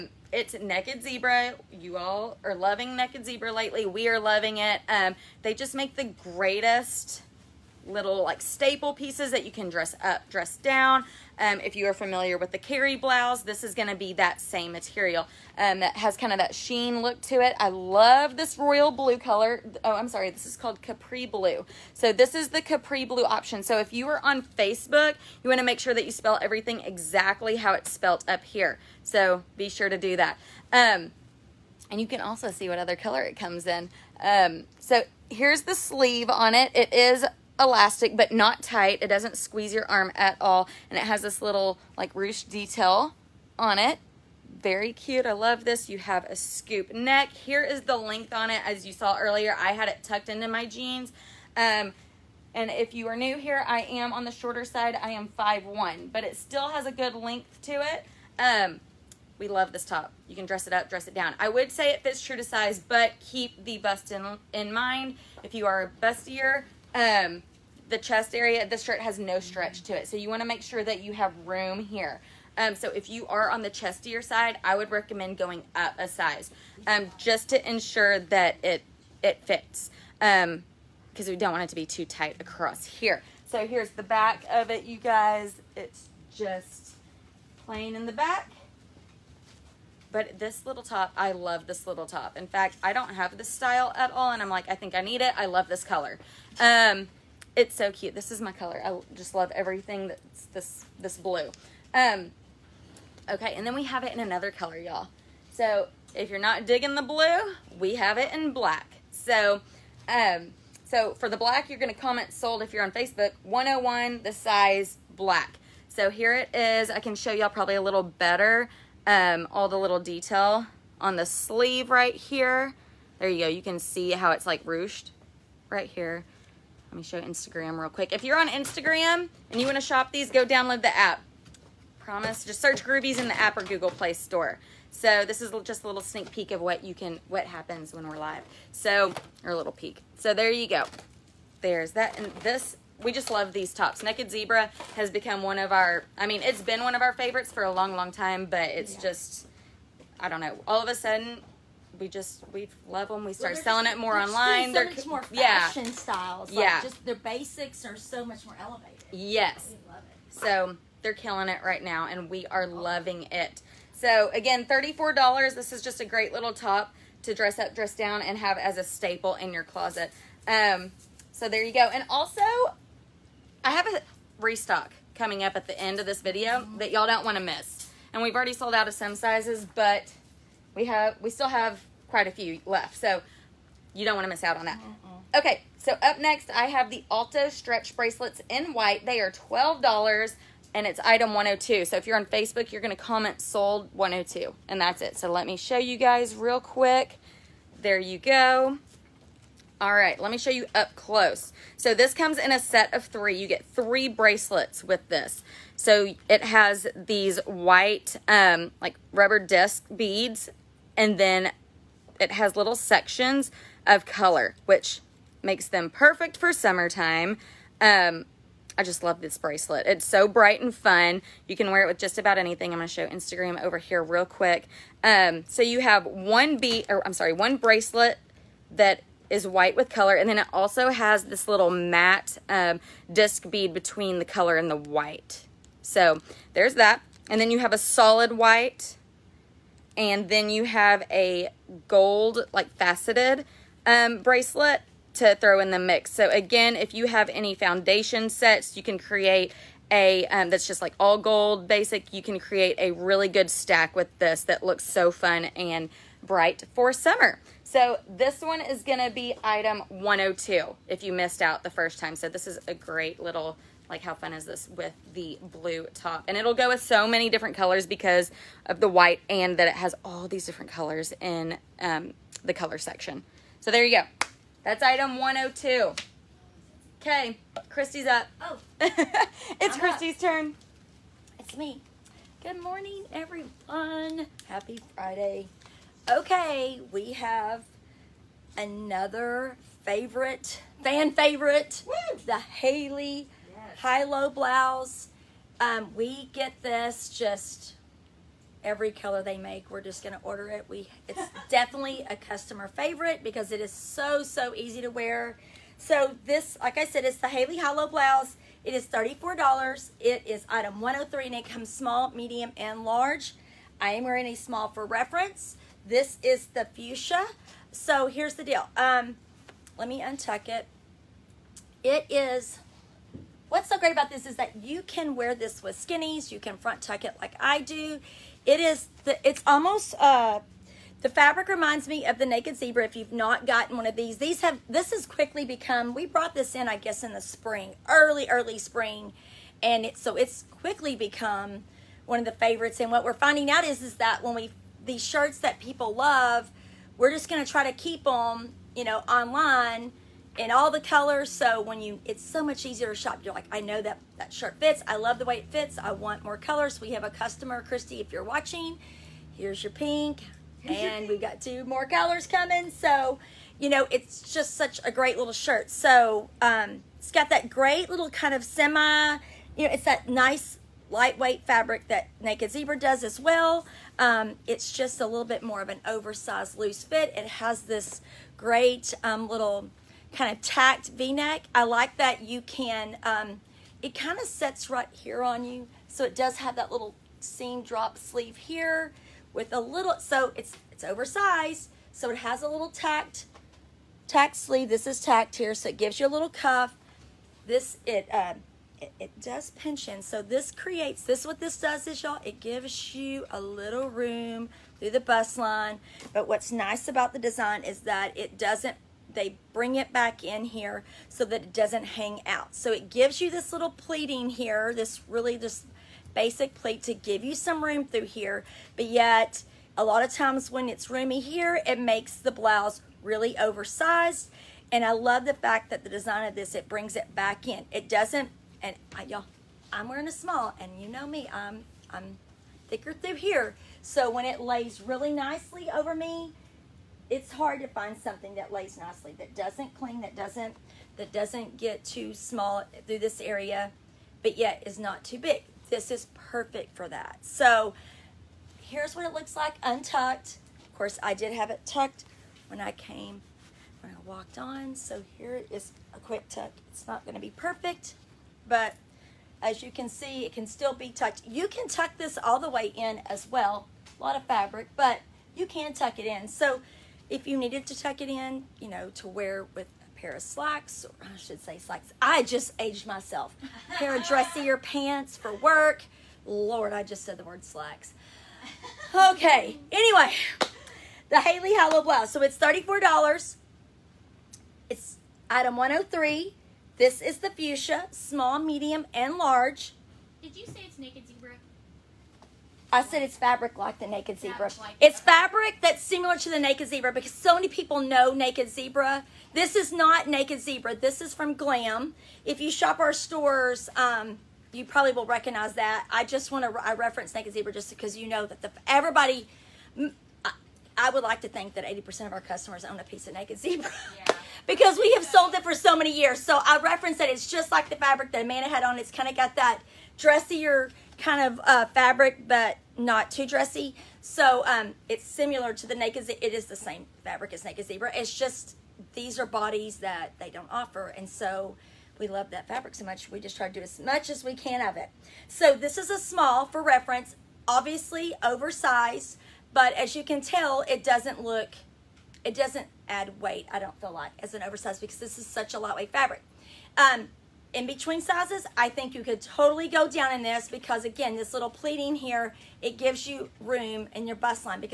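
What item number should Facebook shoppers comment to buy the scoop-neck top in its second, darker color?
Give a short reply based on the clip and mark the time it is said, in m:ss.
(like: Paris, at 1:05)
101, at 1:53.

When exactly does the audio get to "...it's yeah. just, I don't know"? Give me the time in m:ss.
2:28.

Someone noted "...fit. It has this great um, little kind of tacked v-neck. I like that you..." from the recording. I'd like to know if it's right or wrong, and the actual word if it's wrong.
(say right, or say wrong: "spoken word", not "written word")
right.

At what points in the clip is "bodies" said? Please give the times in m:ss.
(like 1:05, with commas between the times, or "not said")
8:49.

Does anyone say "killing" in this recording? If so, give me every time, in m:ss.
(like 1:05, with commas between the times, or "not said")
2:41.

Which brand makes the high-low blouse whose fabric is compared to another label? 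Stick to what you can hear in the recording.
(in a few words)
Glam.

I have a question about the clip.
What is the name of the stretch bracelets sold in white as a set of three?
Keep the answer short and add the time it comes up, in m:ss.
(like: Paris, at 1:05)
Alto, at 3:07.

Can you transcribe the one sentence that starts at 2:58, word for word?
And we've already sold out of some sizes, but we have we still have quite a few left.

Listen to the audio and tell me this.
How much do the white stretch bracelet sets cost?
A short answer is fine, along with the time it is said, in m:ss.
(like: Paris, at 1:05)
$12, at 3:09.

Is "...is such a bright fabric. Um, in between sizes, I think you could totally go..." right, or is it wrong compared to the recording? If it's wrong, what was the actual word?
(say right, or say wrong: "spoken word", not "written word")
wrong: "lightweight", not "bright".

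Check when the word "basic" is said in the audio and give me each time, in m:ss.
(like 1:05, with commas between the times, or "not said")
2:37, 4:11, 6:56.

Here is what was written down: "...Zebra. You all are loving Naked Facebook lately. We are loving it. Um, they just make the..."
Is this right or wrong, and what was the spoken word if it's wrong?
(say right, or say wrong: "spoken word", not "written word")
wrong: "Zebra", not "Facebook".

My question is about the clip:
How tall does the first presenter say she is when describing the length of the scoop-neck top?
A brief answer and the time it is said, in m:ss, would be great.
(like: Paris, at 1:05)
5'1", at 0:55.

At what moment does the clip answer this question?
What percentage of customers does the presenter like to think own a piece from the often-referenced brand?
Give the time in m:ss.
8:31.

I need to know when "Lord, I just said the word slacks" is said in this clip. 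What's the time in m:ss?
7:56.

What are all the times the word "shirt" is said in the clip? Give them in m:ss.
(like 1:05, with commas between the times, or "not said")
1:08, 5:45, 5:54, 6:05.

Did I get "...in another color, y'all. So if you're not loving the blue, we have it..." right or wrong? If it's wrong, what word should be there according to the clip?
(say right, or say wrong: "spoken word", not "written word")
wrong: "digging", not "loving".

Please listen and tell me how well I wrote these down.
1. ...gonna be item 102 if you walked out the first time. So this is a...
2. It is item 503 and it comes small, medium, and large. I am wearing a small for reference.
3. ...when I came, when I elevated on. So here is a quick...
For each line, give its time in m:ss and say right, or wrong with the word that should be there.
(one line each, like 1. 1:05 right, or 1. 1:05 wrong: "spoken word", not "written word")
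1. 4:18 wrong: "missed", not "walked"
2. 5:09 wrong: "103", not "503"
3. 7:32 wrong: "walked", not "elevated".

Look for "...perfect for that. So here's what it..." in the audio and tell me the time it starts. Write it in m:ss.
7:26.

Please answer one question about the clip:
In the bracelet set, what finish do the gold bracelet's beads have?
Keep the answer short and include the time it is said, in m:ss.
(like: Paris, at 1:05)
faceted, at 4:02.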